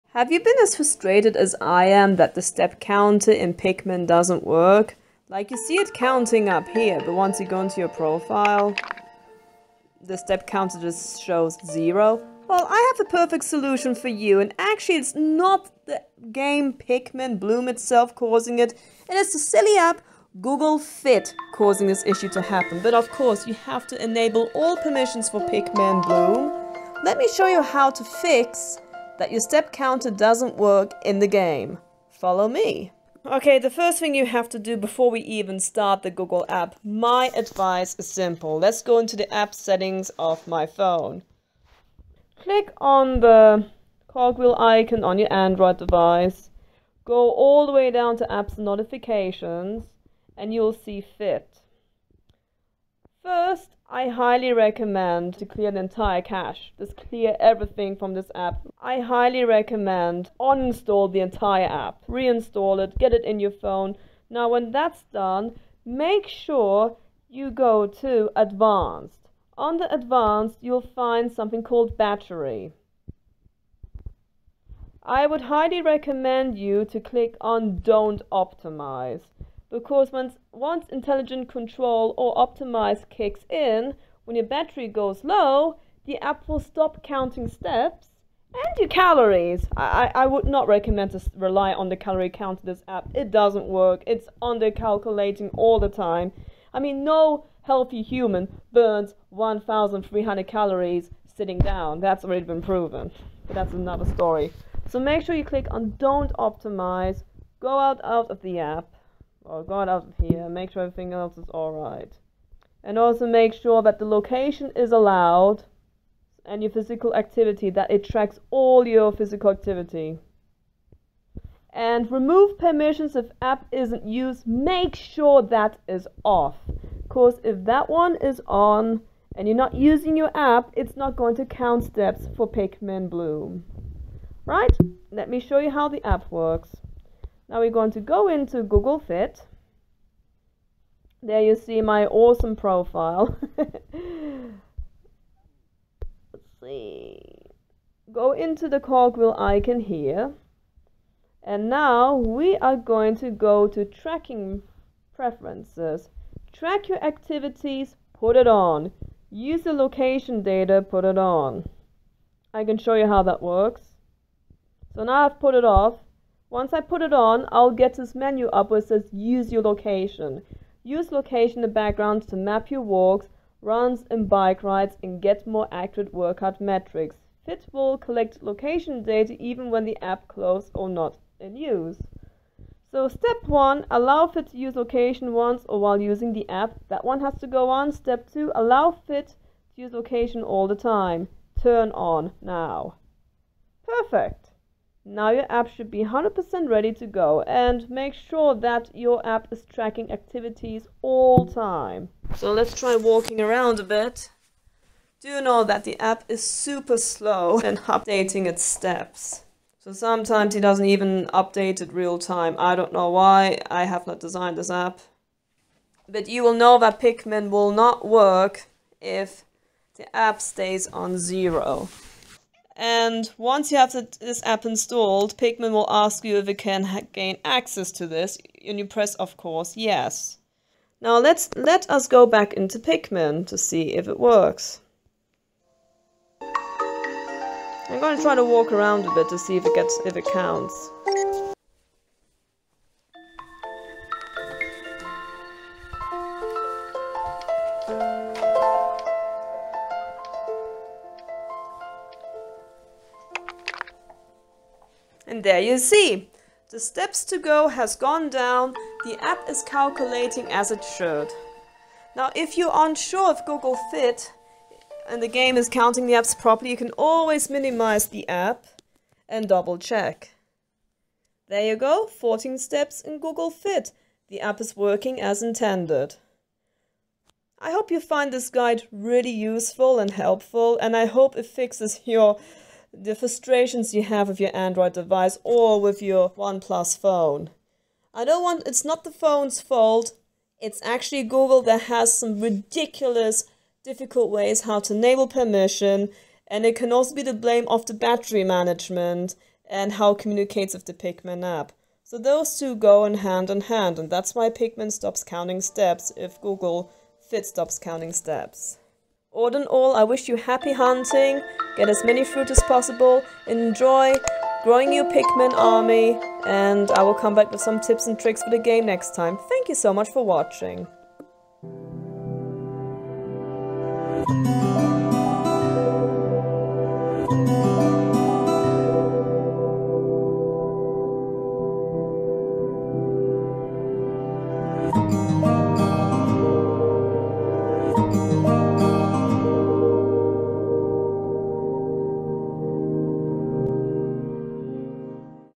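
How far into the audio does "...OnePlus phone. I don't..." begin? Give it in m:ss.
4:46.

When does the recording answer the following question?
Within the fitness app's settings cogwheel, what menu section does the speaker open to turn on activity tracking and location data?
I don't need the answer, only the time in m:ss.
2:33.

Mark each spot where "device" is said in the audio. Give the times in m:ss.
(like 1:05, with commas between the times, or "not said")
0:45, 4:44.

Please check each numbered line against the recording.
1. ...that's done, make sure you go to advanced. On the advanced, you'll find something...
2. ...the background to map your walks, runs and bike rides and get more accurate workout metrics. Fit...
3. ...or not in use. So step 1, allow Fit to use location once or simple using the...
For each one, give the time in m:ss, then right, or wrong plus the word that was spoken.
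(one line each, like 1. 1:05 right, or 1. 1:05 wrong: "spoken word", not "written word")
1. 1:04 right
2. 2:51 right
3. 3:00 wrong: "while", not "simple".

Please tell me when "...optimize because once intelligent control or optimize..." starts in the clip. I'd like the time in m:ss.
1:18.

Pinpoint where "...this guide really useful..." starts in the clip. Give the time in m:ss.
4:38.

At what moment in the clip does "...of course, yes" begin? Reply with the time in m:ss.
3:49.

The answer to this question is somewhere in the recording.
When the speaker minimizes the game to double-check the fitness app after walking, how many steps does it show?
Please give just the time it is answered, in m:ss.
4:32.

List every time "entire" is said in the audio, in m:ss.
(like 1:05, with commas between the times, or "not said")
0:55, 1:01.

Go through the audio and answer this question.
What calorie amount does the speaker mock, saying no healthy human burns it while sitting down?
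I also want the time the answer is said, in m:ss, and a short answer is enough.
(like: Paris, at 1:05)
1,300, at 1:39.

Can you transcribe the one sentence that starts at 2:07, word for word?
Because if that one is on and you're not using your app, it's not going to count steps for Pikmin Bloom.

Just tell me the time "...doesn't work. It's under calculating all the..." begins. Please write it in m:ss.
1:33.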